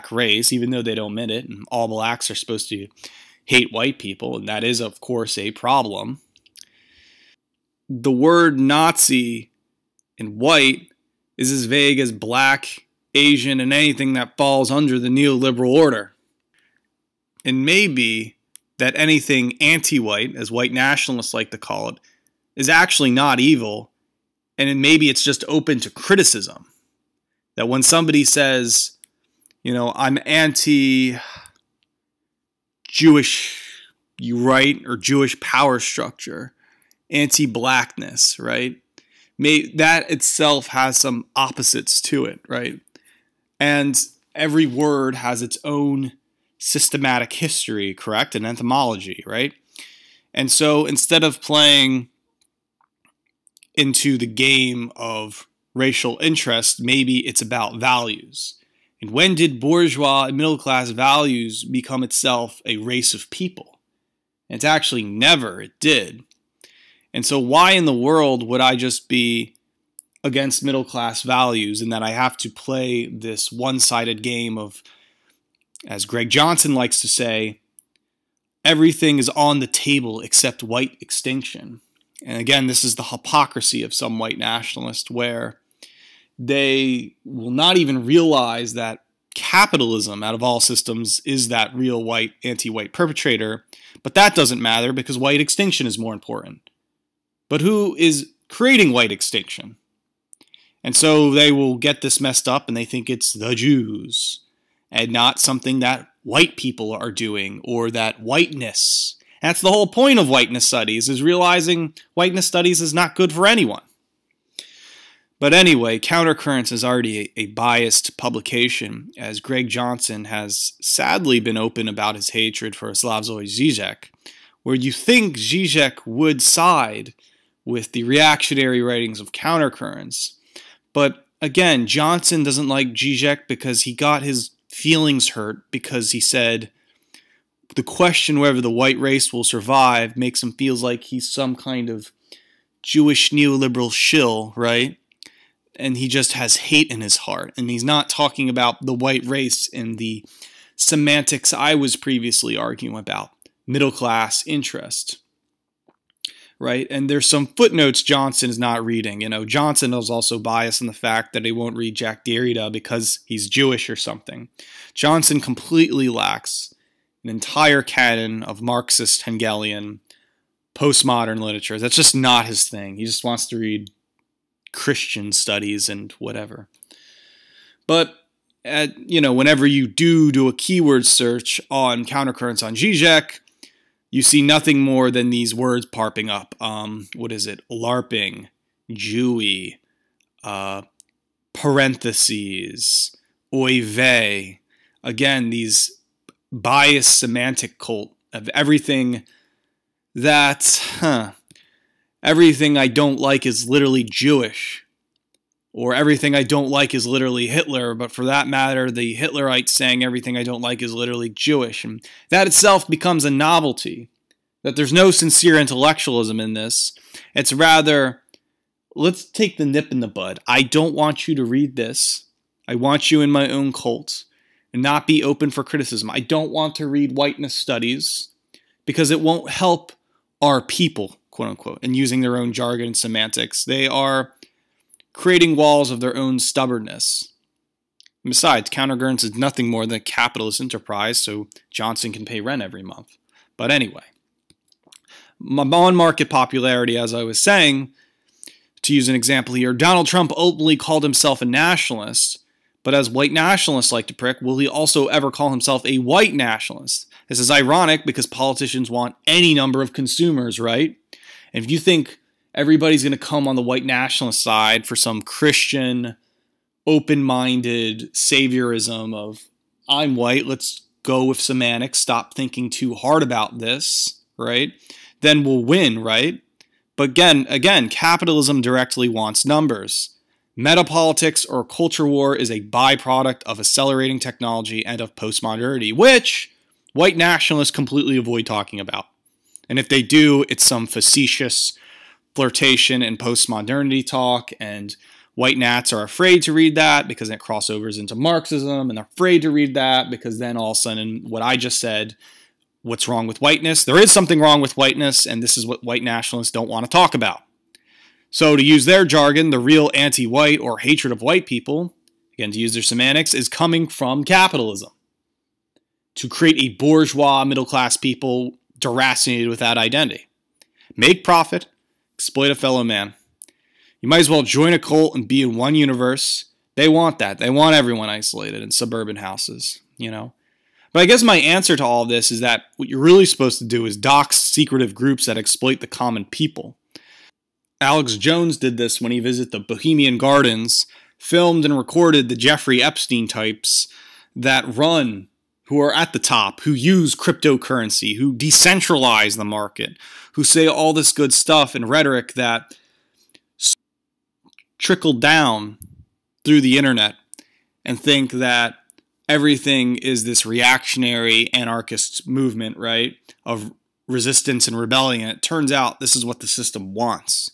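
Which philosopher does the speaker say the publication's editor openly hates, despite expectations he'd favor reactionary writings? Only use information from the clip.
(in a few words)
Slavoj Zizek.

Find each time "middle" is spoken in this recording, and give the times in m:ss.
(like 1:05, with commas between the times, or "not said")
1:00, 1:10, 2:33, 5:17.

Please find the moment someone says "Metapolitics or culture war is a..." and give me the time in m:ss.
4:40.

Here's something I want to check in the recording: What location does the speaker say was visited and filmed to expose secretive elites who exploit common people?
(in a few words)
Bohemian Gardens.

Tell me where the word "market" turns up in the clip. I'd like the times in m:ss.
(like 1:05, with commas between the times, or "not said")
4:05, 5:49.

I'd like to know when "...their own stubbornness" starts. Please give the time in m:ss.
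3:55.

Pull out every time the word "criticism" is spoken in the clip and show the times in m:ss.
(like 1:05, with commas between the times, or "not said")
0:25, 3:45.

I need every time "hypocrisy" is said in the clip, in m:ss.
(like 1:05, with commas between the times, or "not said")
1:23.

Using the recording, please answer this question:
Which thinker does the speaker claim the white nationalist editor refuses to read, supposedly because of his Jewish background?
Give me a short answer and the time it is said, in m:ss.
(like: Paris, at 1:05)
Jacques Derrida, at 2:41.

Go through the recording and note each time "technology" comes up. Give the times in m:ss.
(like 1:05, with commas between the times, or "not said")
4:44.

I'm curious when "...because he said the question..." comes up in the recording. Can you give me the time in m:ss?
2:15.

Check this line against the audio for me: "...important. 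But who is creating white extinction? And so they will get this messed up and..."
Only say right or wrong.
right.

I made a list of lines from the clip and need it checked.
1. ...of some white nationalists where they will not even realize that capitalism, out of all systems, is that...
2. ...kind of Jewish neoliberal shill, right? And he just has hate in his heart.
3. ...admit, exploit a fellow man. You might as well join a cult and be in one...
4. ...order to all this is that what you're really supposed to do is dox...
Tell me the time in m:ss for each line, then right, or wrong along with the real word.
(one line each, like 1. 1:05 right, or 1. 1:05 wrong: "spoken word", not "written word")
1. 1:23 right
2. 2:21 right
3. 5:21 wrong: "profit", not "admit"
4. 5:31 wrong: "answer", not "order".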